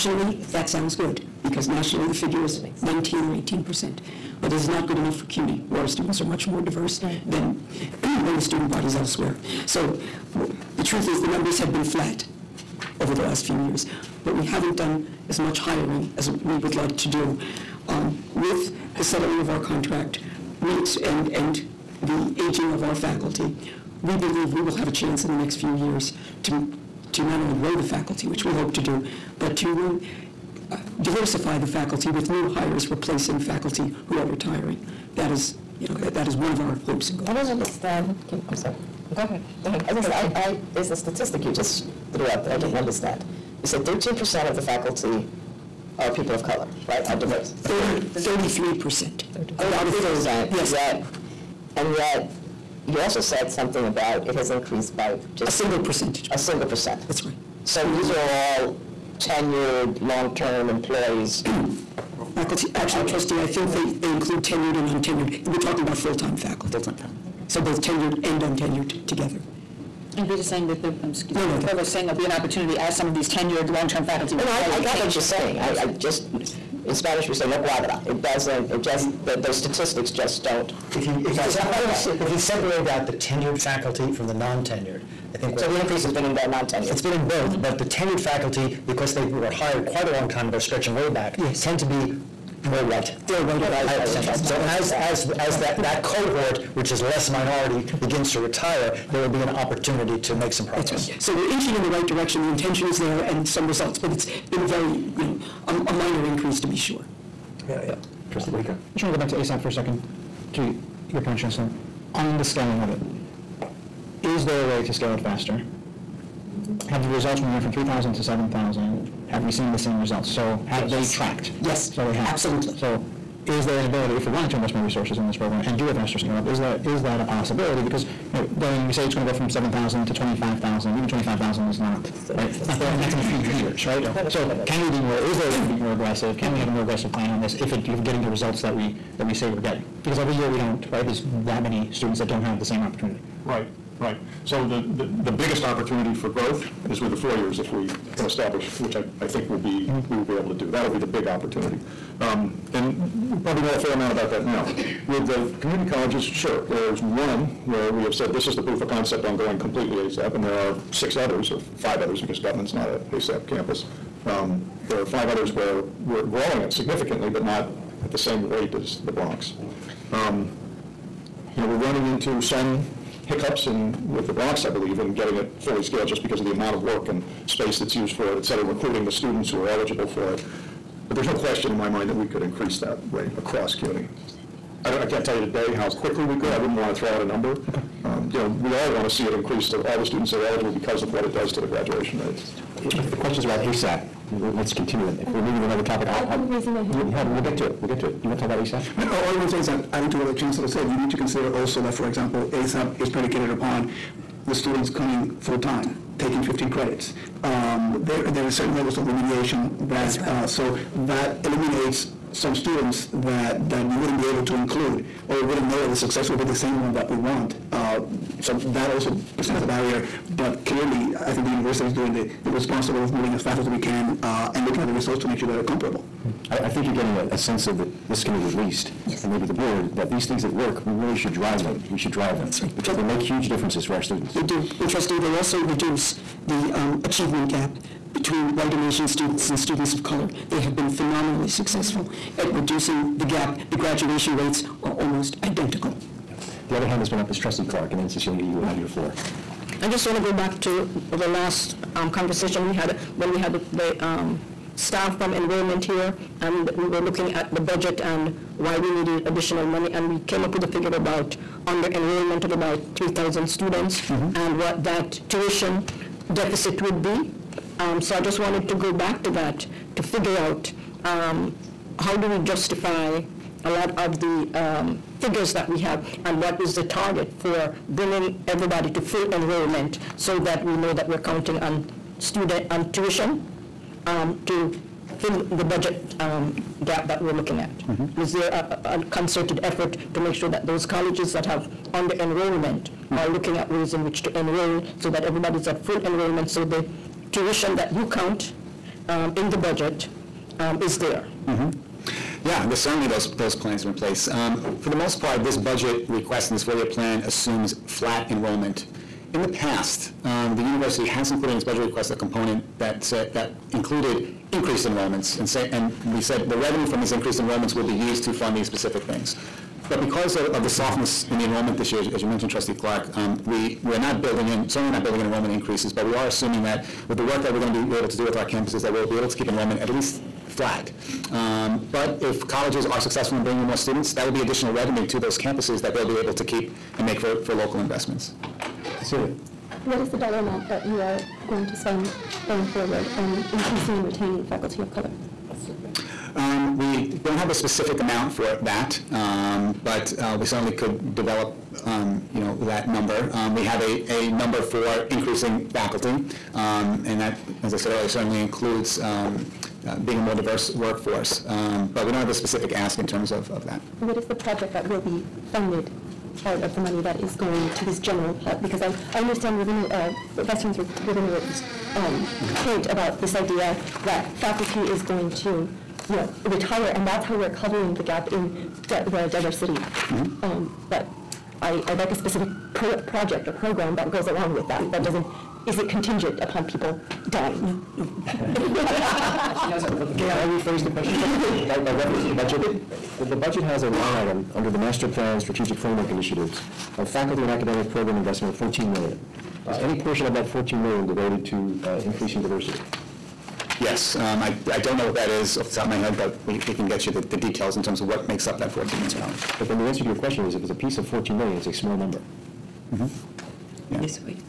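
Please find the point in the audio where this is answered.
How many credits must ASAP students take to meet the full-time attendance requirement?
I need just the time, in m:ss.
3:26.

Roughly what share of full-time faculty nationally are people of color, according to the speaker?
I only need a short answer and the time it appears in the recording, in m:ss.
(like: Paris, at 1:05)
19 or 18 percent, at 0:02.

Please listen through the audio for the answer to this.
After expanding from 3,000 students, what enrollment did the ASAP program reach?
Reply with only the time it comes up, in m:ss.
1:58.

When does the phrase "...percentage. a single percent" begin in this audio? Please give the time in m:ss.
0:55.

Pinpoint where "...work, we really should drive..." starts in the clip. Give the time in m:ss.
3:50.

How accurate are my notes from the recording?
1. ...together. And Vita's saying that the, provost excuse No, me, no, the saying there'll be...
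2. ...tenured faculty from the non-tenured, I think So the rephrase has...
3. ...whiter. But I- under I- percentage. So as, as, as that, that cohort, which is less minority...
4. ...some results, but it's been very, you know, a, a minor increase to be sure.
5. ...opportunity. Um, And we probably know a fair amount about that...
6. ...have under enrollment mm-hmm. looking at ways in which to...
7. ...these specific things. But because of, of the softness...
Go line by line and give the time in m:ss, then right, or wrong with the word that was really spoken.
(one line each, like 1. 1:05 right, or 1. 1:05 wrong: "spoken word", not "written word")
1. 1:09 right
2. 1:23 wrong: "increase", not "rephrase"
3. 1:33 wrong: "higher", not "under"
4. 1:43 right
5. 2:31 right
6. 4:51 right
7. 5:18 right.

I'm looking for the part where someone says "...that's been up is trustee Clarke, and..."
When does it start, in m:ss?
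4:07.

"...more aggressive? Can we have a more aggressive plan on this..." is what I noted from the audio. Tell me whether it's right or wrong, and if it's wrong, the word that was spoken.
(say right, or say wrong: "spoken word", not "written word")
right.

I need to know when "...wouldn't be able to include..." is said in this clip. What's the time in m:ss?
3:33.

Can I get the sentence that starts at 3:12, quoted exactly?
If the question's about ASAP, let's continue If we're moving to another topic, I'll.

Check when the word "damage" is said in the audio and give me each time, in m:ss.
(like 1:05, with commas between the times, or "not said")
not said.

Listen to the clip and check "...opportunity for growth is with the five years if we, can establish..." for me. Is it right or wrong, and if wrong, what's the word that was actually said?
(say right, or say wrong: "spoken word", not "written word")
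wrong: "four", not "five".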